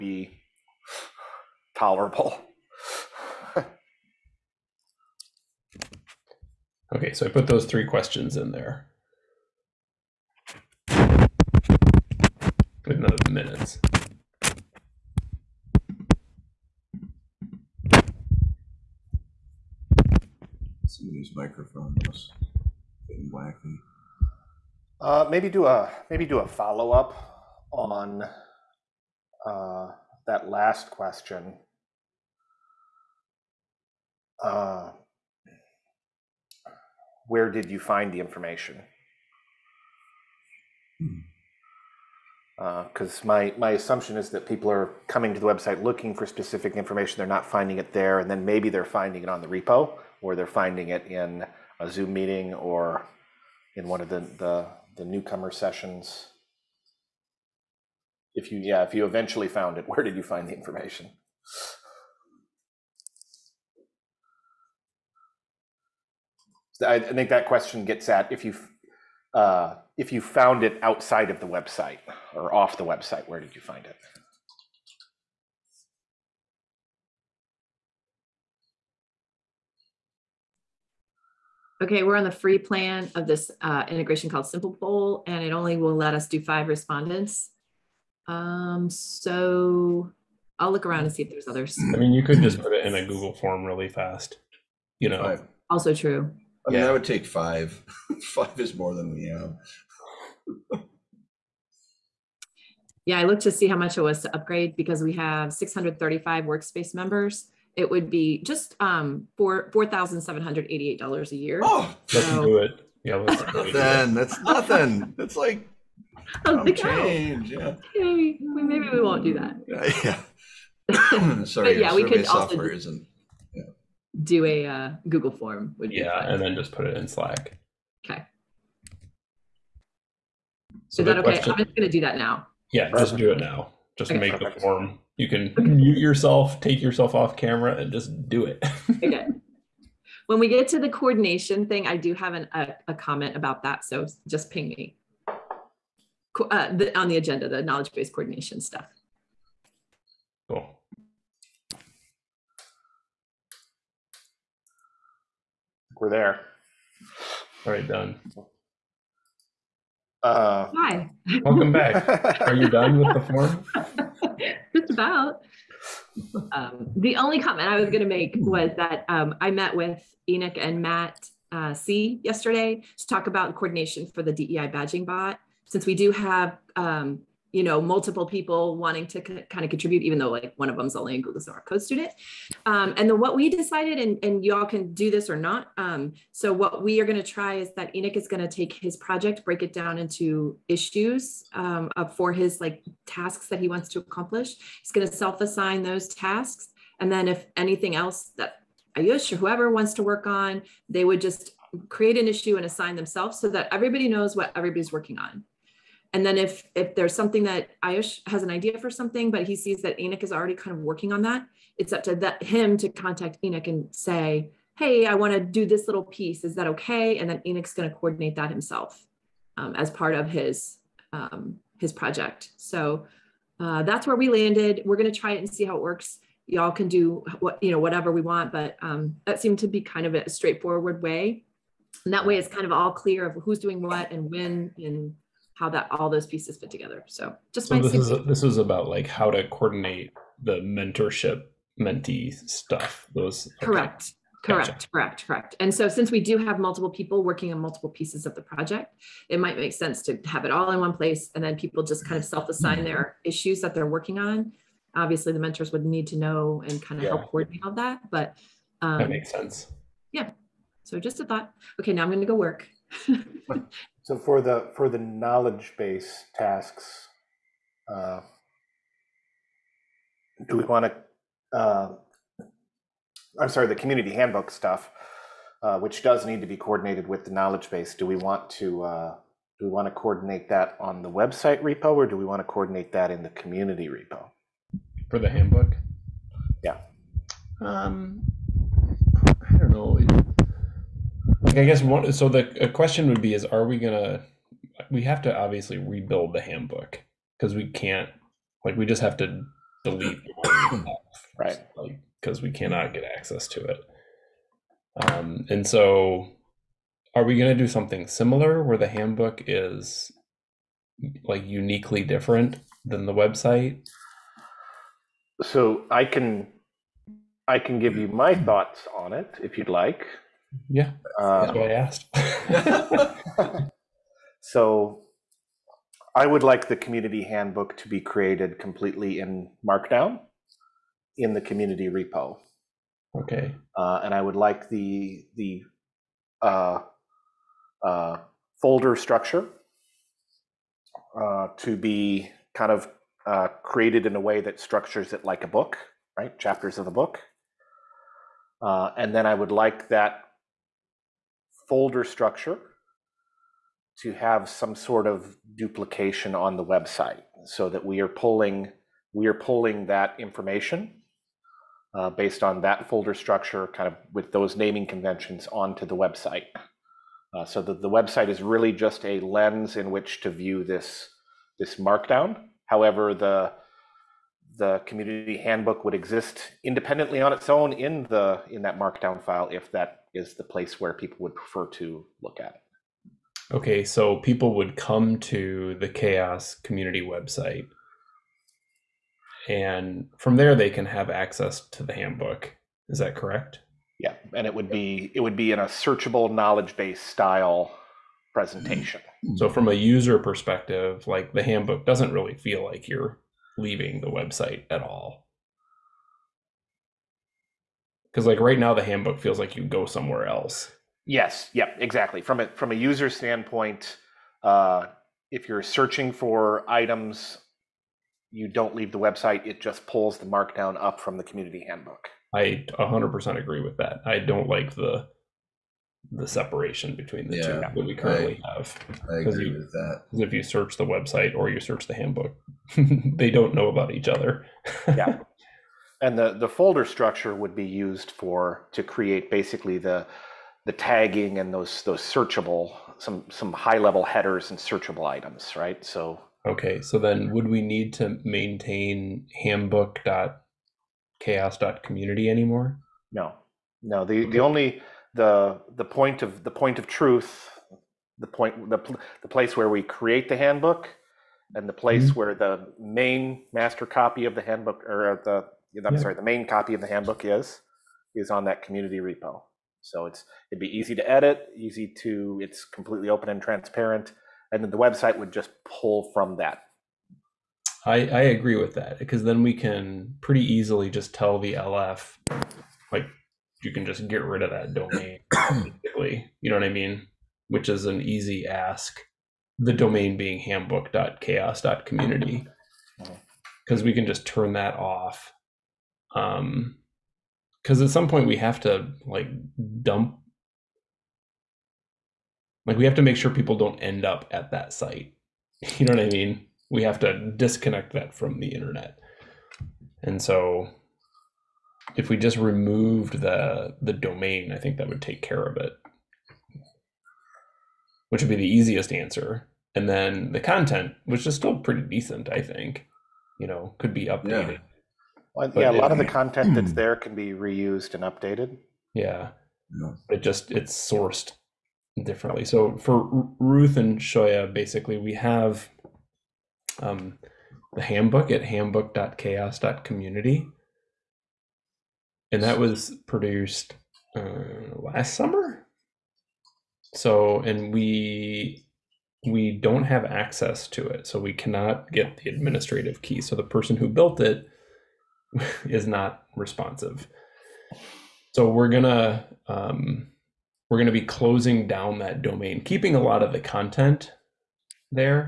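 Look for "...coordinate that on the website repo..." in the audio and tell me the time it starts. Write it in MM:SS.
04:39.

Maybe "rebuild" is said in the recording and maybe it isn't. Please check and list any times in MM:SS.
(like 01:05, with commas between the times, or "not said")
04:55.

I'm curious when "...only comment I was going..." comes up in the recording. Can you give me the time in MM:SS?
02:47.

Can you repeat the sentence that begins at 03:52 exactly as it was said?
And that way, it's kind of all clear of who's doing what and when and how that all those pieces fit together.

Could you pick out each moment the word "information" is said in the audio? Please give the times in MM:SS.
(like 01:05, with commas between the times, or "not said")
00:38, 00:46, 01:00, 06:00.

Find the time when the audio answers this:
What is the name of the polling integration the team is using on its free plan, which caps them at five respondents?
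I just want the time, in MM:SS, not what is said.
01:24.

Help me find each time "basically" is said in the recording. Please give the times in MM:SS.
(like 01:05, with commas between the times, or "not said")
07:19, 08:05, 08:54.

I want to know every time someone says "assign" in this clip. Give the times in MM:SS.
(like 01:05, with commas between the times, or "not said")
03:15, 03:22, 04:12.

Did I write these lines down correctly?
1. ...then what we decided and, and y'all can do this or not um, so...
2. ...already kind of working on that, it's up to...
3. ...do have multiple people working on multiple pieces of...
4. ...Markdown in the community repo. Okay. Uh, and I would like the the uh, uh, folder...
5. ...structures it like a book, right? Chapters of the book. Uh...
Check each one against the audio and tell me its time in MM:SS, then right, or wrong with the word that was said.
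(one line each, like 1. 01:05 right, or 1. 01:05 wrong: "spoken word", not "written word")
1. 03:03 right
2. 03:30 right
3. 04:06 right
4. 05:29 right
5. 05:44 right.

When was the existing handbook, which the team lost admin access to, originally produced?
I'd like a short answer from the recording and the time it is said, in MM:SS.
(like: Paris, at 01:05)
last summer, at 09:04.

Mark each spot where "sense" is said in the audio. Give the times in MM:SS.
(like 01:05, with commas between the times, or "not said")
04:09, 04:19.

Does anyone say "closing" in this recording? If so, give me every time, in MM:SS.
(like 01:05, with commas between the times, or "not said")
09:21.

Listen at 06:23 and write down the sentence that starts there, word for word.
Okay, so people would come to the CHAOSS community website.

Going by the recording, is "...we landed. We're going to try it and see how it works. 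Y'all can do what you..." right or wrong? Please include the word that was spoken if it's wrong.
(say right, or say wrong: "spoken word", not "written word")
right.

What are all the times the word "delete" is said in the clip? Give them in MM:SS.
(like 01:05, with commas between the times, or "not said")
04:59.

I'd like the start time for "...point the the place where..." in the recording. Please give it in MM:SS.
07:38.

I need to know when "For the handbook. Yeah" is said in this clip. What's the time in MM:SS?
04:45.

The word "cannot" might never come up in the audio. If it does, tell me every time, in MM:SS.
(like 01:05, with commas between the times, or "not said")
05:02, 09:11.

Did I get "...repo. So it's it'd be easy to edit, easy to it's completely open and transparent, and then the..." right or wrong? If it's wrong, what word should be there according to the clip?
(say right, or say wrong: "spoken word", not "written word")
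right.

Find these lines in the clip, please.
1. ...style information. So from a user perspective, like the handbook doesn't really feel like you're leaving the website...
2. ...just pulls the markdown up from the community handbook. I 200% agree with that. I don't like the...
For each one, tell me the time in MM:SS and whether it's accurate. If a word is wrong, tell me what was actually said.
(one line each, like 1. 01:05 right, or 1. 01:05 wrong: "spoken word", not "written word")
1. 06:36 wrong: "presentation", not "information"
2. 06:59 wrong: "100", not "200".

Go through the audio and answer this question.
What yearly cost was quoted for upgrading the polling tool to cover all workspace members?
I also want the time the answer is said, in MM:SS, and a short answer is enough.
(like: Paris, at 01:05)
$4,788, at 01:49.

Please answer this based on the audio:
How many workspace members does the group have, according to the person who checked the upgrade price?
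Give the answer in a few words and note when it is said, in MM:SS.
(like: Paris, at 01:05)
635, at 01:45.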